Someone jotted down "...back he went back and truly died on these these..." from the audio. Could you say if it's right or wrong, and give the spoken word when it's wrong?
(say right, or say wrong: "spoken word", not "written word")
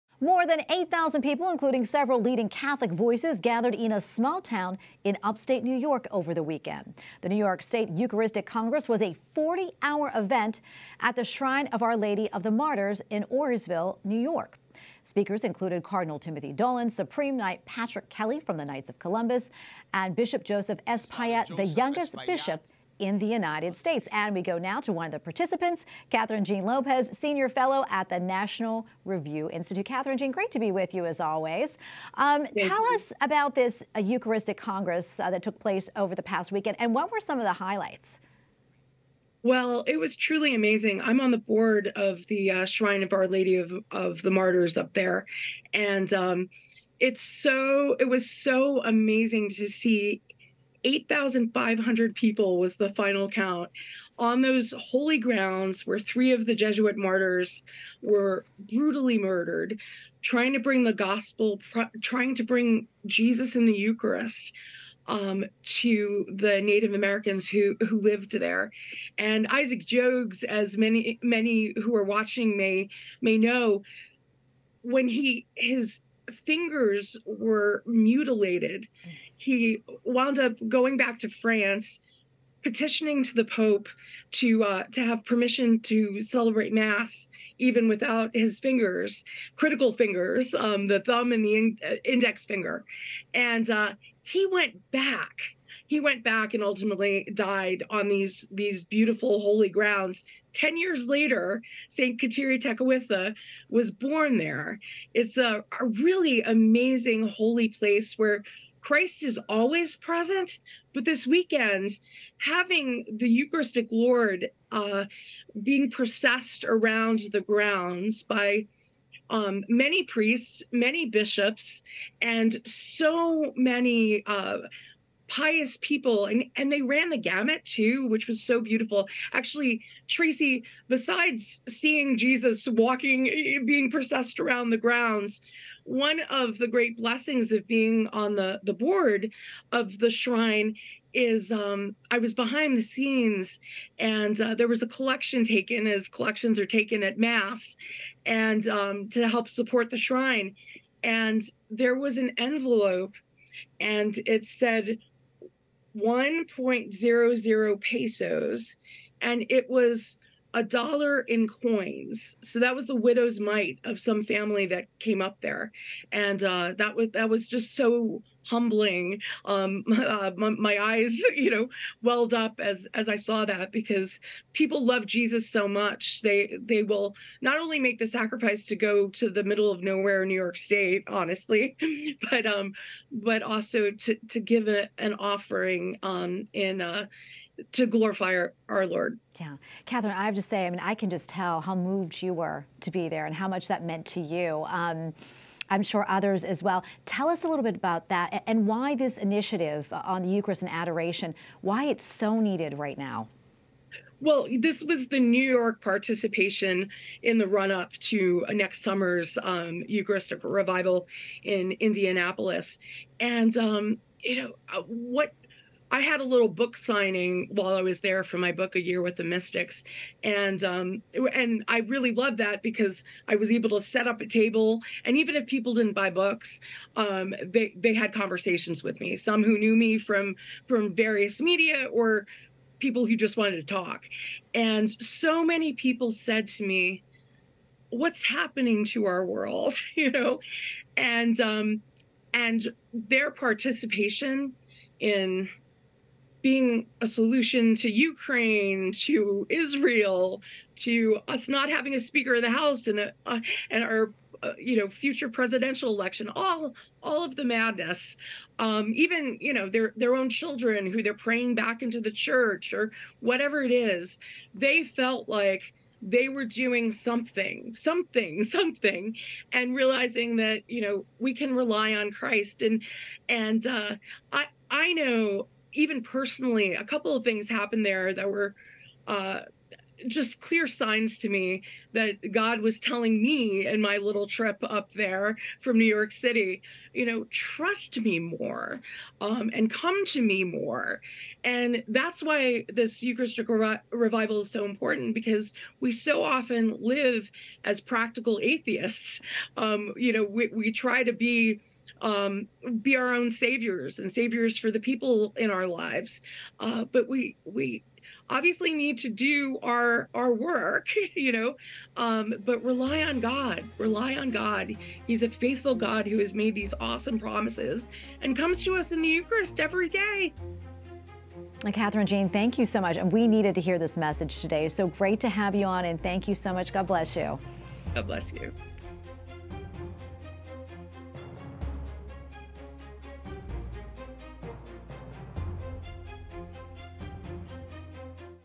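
wrong: "ultimately", not "truly".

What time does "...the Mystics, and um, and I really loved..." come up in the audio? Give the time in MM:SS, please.
03:39.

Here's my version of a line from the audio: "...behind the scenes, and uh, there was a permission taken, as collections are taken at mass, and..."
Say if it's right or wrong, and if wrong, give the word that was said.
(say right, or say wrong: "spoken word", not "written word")
wrong: "collection", not "permission".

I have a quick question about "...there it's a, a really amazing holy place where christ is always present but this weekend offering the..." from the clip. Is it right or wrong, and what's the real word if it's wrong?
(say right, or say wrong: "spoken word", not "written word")
wrong: "having", not "offering".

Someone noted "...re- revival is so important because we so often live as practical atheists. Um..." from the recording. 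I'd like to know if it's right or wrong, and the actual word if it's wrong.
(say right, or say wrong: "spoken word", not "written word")
right.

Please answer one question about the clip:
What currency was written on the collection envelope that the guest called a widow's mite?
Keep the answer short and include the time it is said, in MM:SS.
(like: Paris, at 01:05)
pesos, at 02:37.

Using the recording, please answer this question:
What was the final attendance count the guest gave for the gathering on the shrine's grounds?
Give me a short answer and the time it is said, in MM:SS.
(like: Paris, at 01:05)
8,500, at 00:50.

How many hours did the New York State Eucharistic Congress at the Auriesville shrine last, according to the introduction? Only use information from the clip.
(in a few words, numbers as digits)
40.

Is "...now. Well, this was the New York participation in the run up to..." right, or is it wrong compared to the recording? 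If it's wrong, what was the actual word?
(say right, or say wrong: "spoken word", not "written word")
right.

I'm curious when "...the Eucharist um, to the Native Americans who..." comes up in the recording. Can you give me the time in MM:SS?
01:03.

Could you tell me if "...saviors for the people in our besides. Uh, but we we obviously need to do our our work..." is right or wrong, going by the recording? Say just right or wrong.
wrong.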